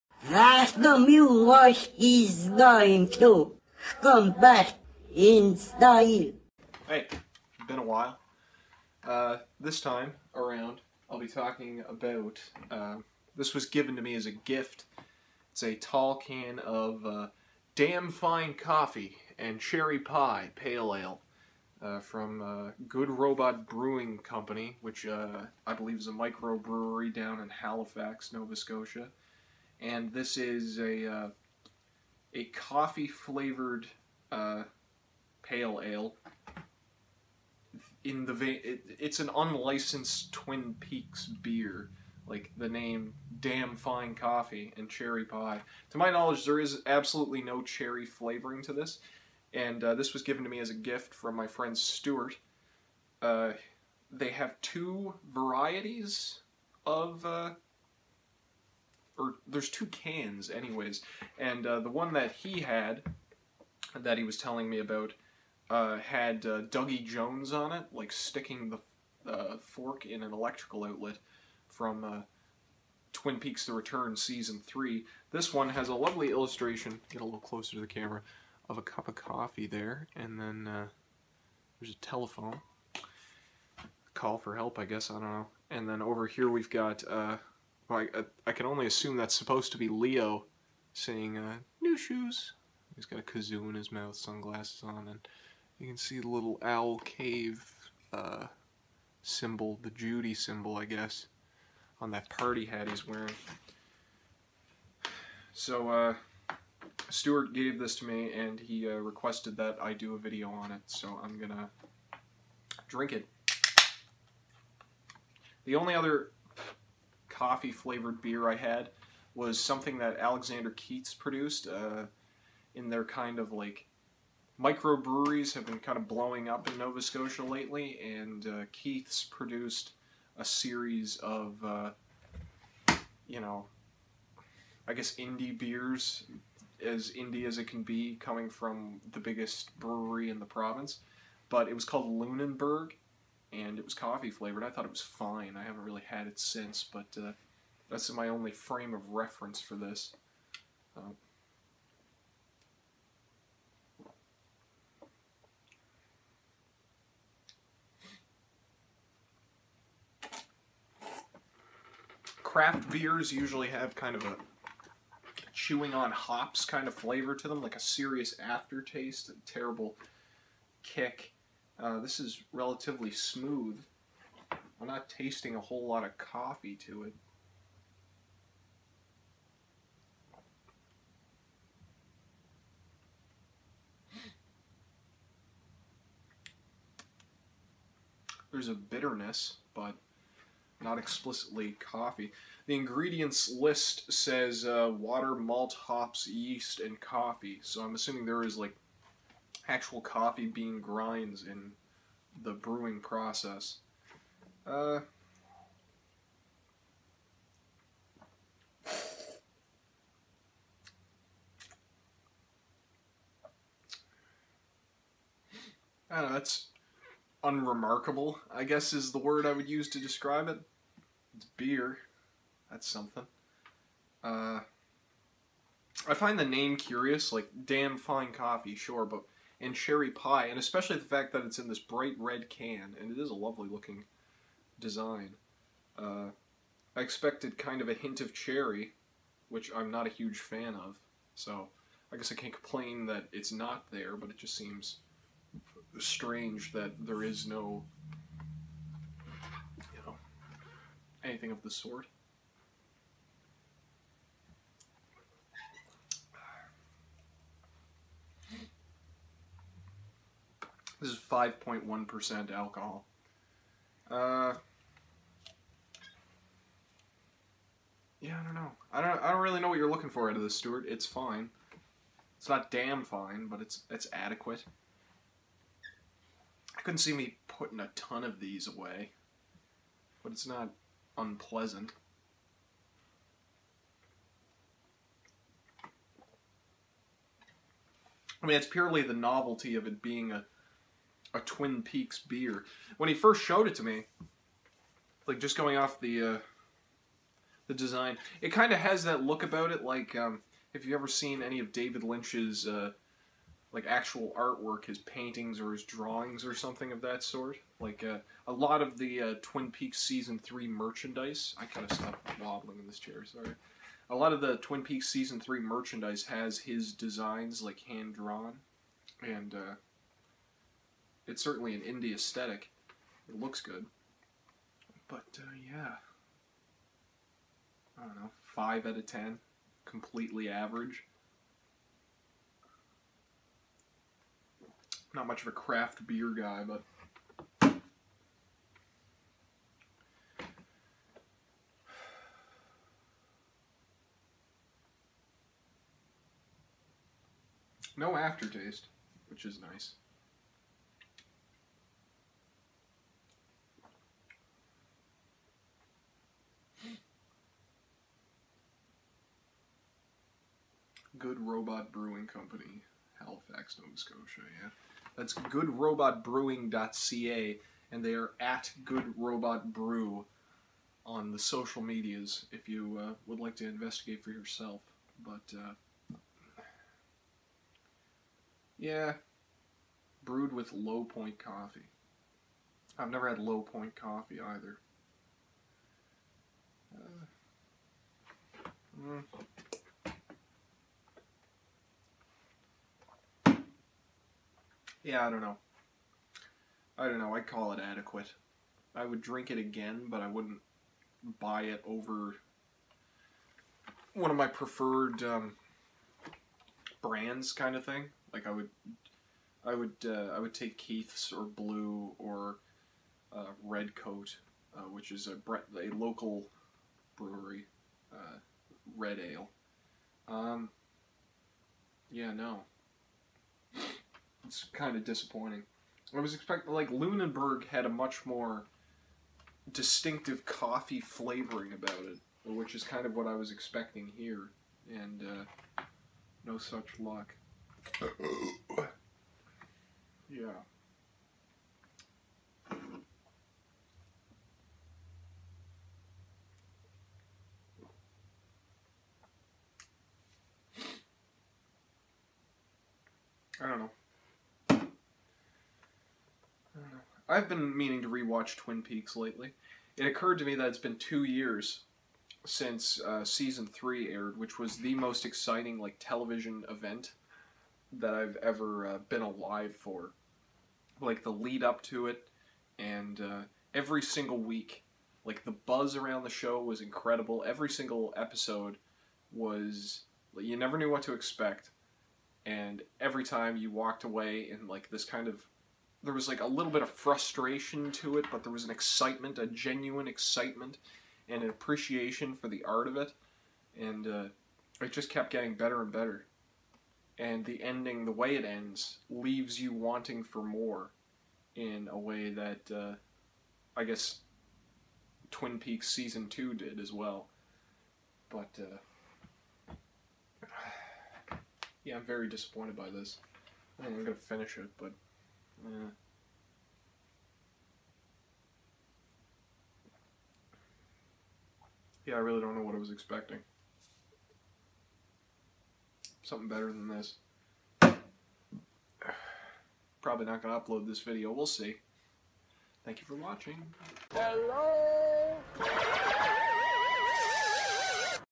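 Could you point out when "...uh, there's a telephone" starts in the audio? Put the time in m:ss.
1:20.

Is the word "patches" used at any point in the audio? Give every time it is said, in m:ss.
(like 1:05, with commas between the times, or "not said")
not said.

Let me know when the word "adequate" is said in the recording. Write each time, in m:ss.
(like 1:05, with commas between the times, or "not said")
4:34, 6:37.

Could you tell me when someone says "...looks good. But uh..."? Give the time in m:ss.
5:23.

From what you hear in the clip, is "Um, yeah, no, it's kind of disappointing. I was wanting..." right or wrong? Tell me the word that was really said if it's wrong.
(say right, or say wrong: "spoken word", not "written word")
wrong: "expecting", not "wanting".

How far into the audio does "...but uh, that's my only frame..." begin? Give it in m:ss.
2:26.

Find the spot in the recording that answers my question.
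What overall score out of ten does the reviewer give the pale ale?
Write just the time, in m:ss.
5:28.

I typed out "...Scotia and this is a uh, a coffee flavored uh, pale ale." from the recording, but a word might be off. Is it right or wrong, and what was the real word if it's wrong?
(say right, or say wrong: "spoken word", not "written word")
right.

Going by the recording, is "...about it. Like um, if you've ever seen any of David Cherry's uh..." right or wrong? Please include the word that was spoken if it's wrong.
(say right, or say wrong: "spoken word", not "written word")
wrong: "Lynch", not "Cherry".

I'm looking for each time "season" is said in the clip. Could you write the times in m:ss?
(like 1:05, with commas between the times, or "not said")
1:14, 5:10, 5:15, 7:43, 8:25.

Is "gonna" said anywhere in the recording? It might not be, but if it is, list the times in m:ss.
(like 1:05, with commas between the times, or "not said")
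1:51, 8:34.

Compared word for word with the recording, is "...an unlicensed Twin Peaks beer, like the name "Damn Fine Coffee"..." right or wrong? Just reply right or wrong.
right.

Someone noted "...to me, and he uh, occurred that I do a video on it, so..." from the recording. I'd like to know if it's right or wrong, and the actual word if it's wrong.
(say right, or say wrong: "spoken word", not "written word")
wrong: "requested", not "occurred".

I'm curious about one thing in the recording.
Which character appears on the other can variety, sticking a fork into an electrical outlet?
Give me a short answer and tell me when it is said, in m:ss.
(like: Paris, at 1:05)
Dougie Jones, at 1:06.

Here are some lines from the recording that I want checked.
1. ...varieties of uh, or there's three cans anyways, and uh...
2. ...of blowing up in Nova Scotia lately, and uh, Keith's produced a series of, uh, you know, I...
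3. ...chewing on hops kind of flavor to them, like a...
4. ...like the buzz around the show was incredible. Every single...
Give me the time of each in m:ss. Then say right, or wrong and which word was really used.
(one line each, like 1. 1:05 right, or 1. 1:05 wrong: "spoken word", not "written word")
1. 0:55 wrong: "two", not "three"
2. 2:05 right
3. 2:45 right
4. 7:55 right.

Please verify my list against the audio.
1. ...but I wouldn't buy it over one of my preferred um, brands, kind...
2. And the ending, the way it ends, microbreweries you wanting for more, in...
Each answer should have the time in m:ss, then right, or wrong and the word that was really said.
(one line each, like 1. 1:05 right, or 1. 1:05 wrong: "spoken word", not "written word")
1. 6:40 right
2. 8:17 wrong: "leaves", not "microbreweries".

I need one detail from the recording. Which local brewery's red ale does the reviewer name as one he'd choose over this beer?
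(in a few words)
Red Coat.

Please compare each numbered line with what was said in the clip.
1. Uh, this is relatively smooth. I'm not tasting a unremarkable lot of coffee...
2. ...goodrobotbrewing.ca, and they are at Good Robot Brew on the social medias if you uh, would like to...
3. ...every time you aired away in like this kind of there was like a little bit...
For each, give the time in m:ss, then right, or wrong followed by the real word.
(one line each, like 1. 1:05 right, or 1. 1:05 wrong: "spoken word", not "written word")
1. 2:51 wrong: "whole", not "unremarkable"
2. 6:05 right
3. 8:02 wrong: "walked", not "aired".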